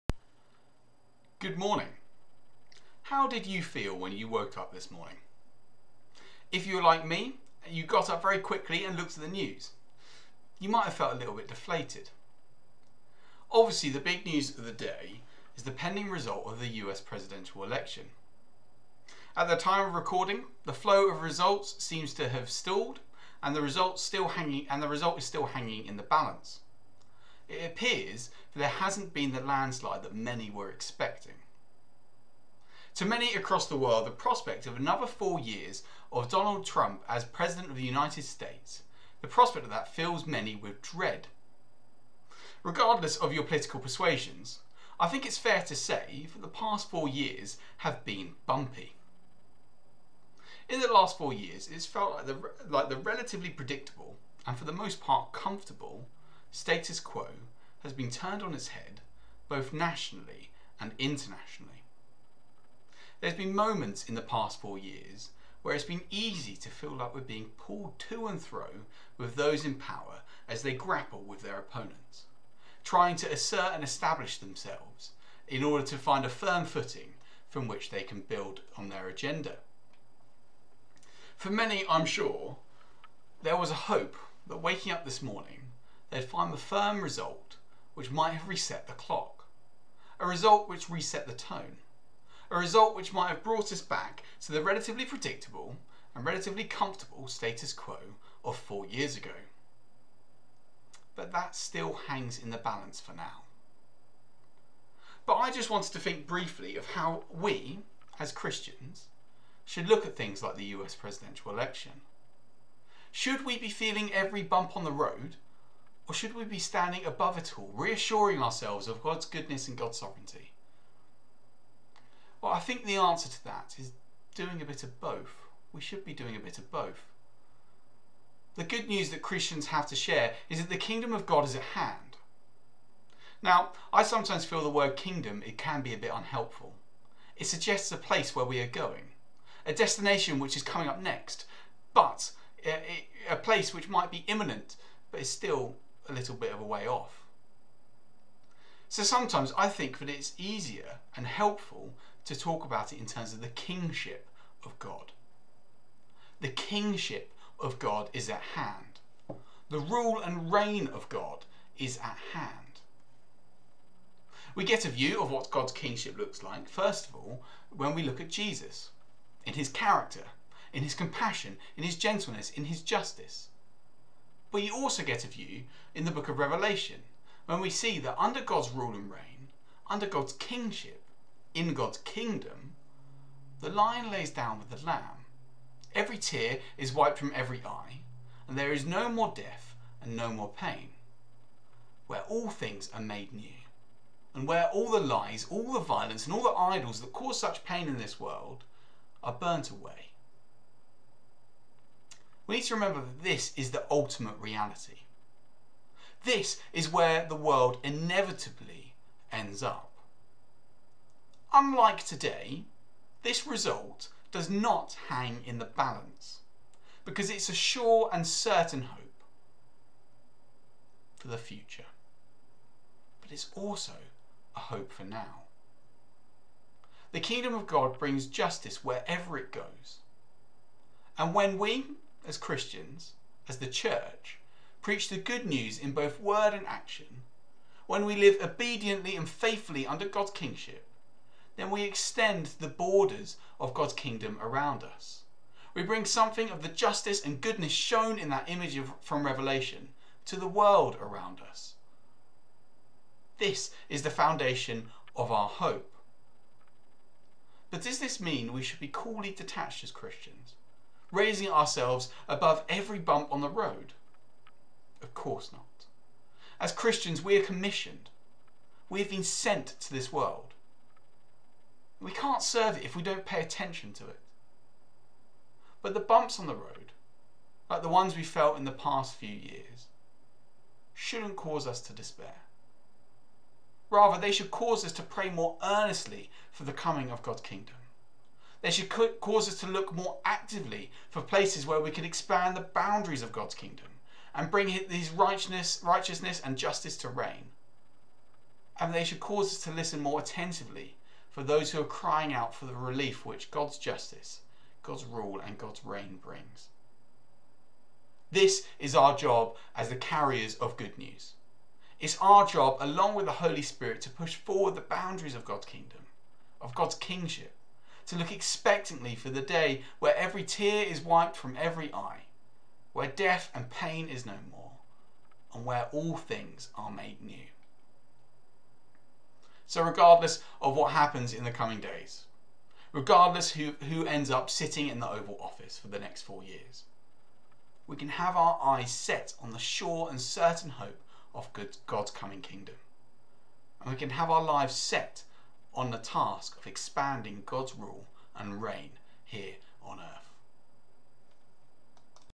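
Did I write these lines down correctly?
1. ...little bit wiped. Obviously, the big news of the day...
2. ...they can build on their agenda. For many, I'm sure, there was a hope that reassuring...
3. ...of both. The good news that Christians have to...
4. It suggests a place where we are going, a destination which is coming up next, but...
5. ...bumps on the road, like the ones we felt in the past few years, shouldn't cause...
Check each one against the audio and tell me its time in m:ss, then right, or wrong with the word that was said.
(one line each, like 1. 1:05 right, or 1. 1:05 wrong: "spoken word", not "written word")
1. 0:11 wrong: "deflated", not "wiped"
2. 1:17 wrong: "waking", not "reassuring"
3. 2:06 right
4. 2:17 right
5. 4:35 right.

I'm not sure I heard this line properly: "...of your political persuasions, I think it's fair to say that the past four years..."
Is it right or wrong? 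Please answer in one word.
right.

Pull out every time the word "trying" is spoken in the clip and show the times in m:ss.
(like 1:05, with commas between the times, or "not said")
1:12.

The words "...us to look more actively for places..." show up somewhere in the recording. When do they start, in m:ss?
4:49.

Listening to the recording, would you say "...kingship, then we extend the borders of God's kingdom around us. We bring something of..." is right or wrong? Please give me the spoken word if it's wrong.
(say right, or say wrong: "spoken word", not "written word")
right.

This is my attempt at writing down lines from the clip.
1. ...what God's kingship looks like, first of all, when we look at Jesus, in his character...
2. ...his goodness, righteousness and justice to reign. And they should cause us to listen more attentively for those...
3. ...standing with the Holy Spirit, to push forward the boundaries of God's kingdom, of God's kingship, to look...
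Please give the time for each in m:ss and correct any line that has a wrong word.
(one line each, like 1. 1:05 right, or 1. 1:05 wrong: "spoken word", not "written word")
1. 2:45 right
2. 4:54 wrong: "righteousness", not "goodness"
3. 5:12 wrong: "along", not "standing".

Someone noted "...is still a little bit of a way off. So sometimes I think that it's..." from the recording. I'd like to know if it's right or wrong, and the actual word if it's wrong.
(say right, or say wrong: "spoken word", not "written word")
right.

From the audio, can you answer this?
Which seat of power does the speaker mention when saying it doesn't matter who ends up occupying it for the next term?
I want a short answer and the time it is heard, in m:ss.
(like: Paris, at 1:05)
The Oval Office, at 5:35.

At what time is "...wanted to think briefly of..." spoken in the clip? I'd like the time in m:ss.
1:45.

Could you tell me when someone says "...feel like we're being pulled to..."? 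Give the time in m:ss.
1:06.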